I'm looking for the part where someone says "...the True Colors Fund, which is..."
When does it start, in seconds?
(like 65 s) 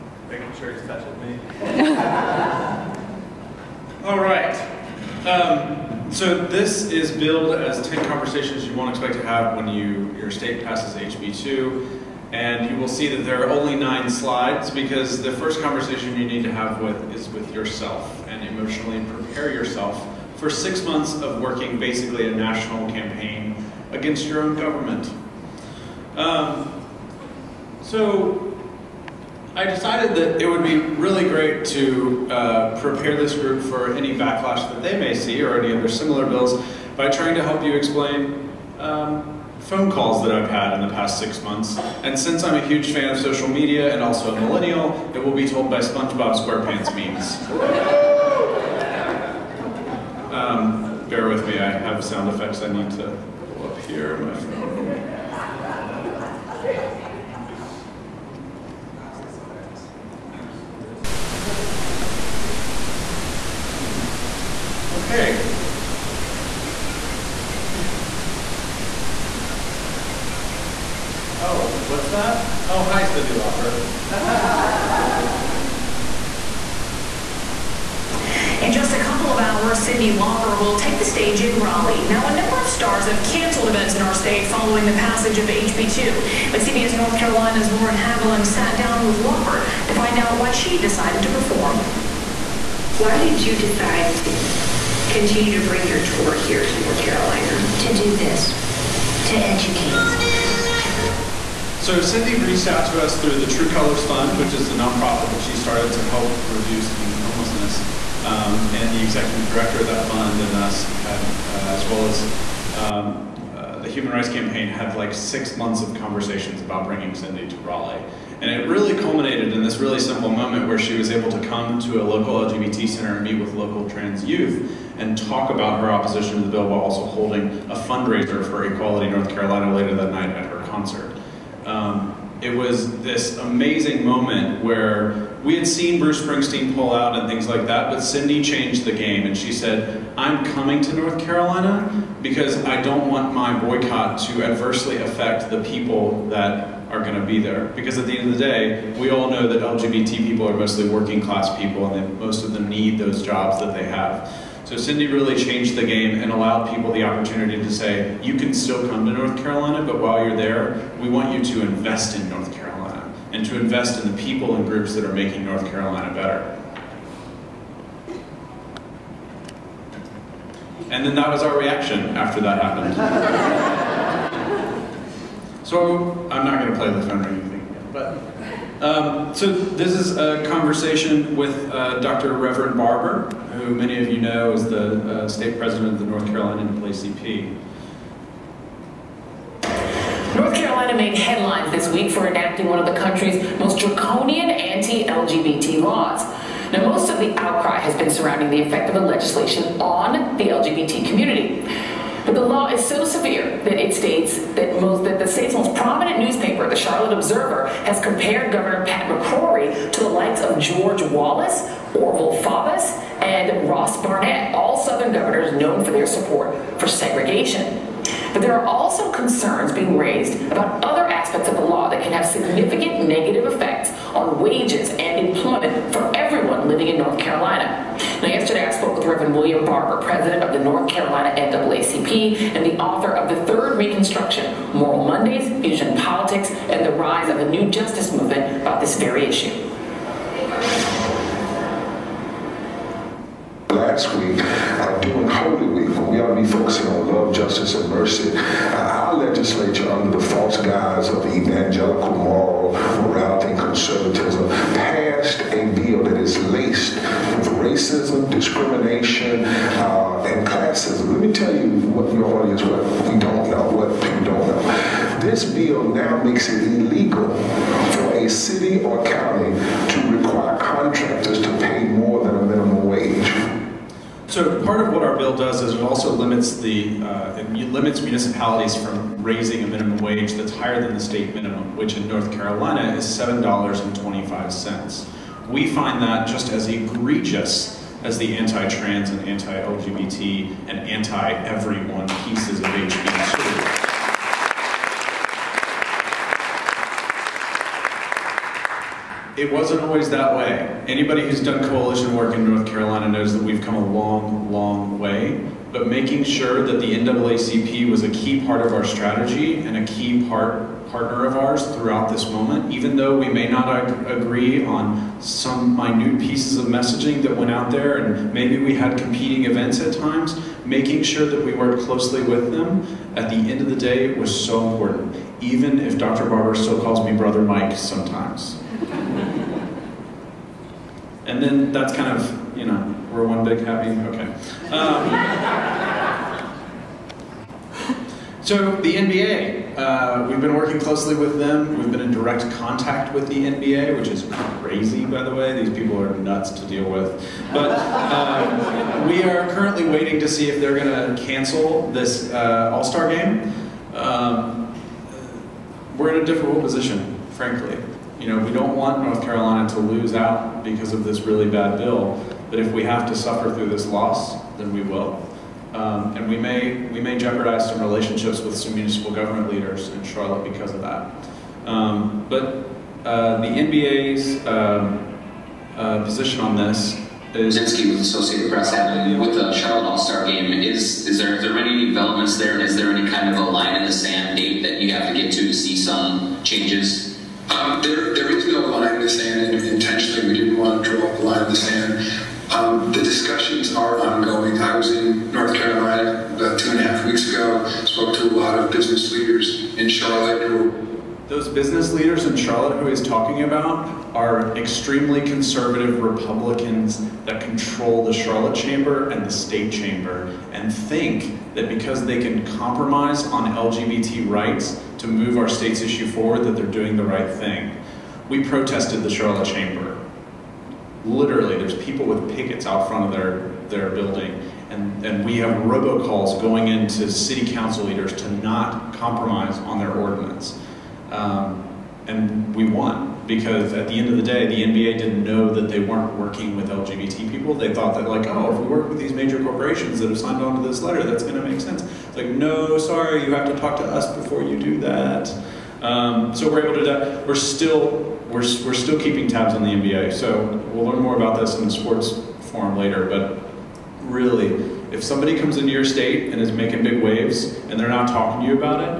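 103 s.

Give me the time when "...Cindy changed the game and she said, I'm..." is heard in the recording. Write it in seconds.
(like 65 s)
137 s.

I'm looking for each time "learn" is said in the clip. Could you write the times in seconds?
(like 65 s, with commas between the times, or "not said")
450 s.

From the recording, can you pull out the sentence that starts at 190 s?
North Carolina made headlines this week for enacting one of the country's most draconian anti-LGBT laws.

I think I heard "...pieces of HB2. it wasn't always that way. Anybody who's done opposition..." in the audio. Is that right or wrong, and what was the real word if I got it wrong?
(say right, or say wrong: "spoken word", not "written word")
wrong: "coalition", not "opposition".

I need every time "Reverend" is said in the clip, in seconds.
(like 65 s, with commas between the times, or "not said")
182 s, 229 s.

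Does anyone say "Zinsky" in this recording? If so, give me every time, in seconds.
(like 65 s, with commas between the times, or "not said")
377 s.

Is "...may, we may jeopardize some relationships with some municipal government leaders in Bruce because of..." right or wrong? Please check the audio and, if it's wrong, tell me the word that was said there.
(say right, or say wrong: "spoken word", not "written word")
wrong: "Charlotte", not "Bruce".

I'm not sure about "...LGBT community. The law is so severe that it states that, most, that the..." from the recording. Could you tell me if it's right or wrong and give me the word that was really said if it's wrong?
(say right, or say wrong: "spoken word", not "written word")
right.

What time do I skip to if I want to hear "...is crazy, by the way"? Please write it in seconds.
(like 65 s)
344 s.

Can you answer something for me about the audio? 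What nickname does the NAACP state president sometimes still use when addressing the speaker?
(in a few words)
Brother Mike.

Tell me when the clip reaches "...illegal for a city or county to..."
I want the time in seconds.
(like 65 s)
266 s.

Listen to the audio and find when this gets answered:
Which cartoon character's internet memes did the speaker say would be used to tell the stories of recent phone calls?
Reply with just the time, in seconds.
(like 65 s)
45 s.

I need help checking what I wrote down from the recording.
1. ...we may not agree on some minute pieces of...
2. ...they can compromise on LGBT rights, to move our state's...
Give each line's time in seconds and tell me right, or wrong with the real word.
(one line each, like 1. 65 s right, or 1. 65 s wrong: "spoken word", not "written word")
1. 313 s right
2. 412 s right.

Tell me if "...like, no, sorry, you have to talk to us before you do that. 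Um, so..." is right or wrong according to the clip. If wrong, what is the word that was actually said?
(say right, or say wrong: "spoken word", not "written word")
right.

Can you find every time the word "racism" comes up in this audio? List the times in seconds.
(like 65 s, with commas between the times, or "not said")
257 s.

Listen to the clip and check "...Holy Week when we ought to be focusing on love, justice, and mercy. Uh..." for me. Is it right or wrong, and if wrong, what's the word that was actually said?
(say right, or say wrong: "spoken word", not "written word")
right.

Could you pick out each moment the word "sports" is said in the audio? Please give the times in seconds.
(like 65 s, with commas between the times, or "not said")
451 s.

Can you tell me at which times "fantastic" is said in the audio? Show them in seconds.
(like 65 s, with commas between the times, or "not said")
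not said.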